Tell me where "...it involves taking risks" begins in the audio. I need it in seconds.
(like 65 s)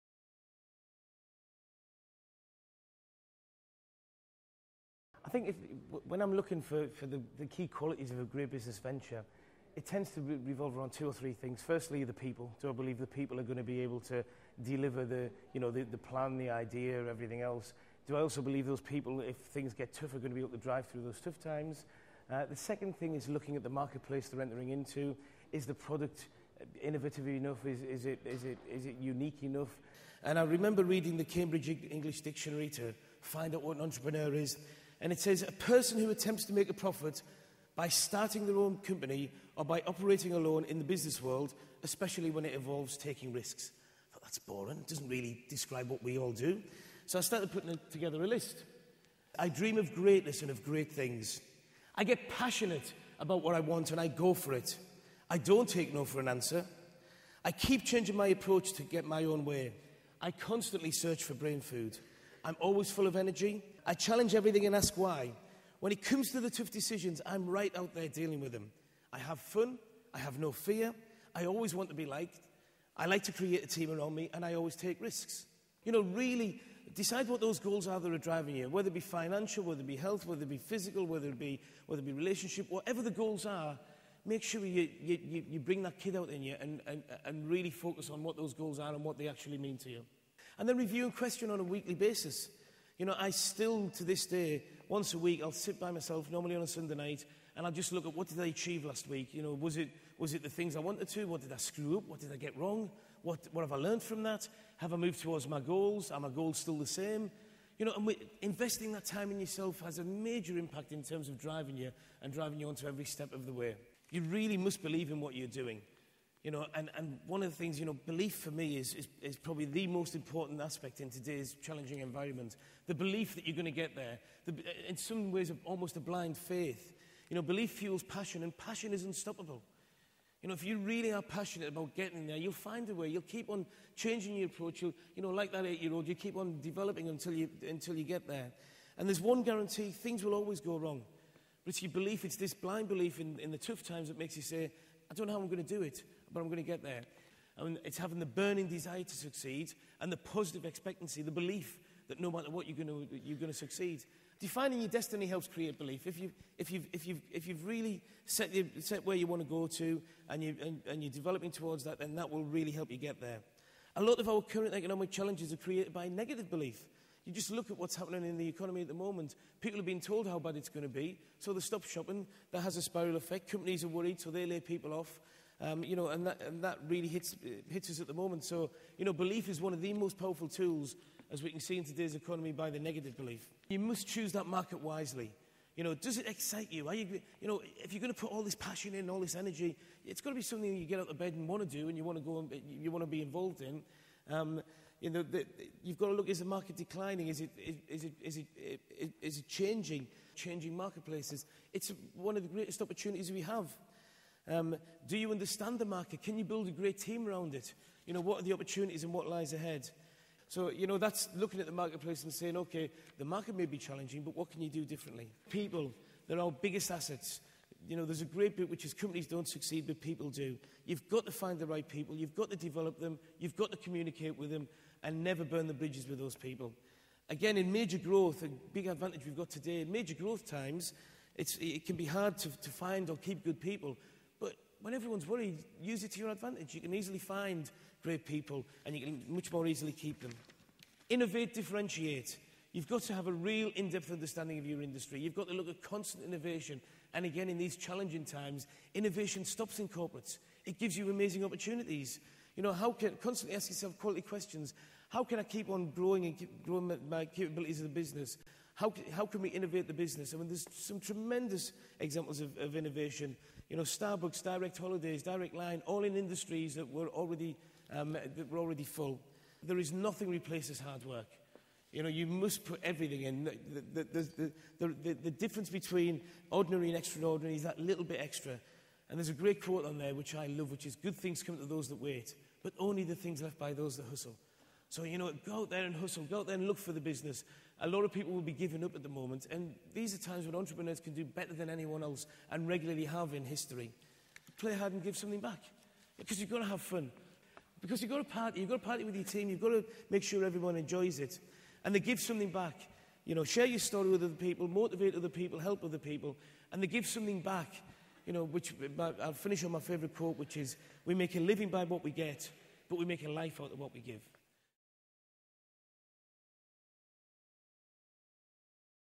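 42 s.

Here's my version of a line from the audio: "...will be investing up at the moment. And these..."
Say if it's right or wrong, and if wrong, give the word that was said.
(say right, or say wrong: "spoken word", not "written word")
wrong: "giving", not "investing".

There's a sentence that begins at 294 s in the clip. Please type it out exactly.
Play hard and give something back.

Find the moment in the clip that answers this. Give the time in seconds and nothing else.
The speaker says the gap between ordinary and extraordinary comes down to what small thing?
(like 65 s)
277 s.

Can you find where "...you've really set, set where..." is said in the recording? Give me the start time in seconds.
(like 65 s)
157 s.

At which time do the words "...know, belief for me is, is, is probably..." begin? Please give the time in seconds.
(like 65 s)
117 s.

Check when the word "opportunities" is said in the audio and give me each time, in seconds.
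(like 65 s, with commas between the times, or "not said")
202 s, 208 s, 251 s.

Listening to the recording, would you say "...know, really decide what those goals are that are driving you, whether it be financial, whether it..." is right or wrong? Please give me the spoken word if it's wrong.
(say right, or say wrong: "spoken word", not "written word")
right.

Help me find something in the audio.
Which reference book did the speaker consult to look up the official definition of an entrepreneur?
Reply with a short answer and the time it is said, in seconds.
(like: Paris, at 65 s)
Cambridge English Dictionary, at 31 s.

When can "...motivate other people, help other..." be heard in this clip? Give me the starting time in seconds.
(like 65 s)
304 s.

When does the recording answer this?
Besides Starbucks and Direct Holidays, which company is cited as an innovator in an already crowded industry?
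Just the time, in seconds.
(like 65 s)
265 s.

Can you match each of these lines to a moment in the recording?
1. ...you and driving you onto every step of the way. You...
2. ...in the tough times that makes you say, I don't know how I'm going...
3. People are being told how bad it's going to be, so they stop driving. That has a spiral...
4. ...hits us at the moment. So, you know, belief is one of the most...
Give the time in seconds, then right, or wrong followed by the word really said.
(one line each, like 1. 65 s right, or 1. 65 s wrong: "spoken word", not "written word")
1. 111 s right
2. 143 s right
3. 169 s wrong: "shopping", not "driving"
4. 177 s right.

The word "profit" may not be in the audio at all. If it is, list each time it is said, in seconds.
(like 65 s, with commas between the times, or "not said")
36 s.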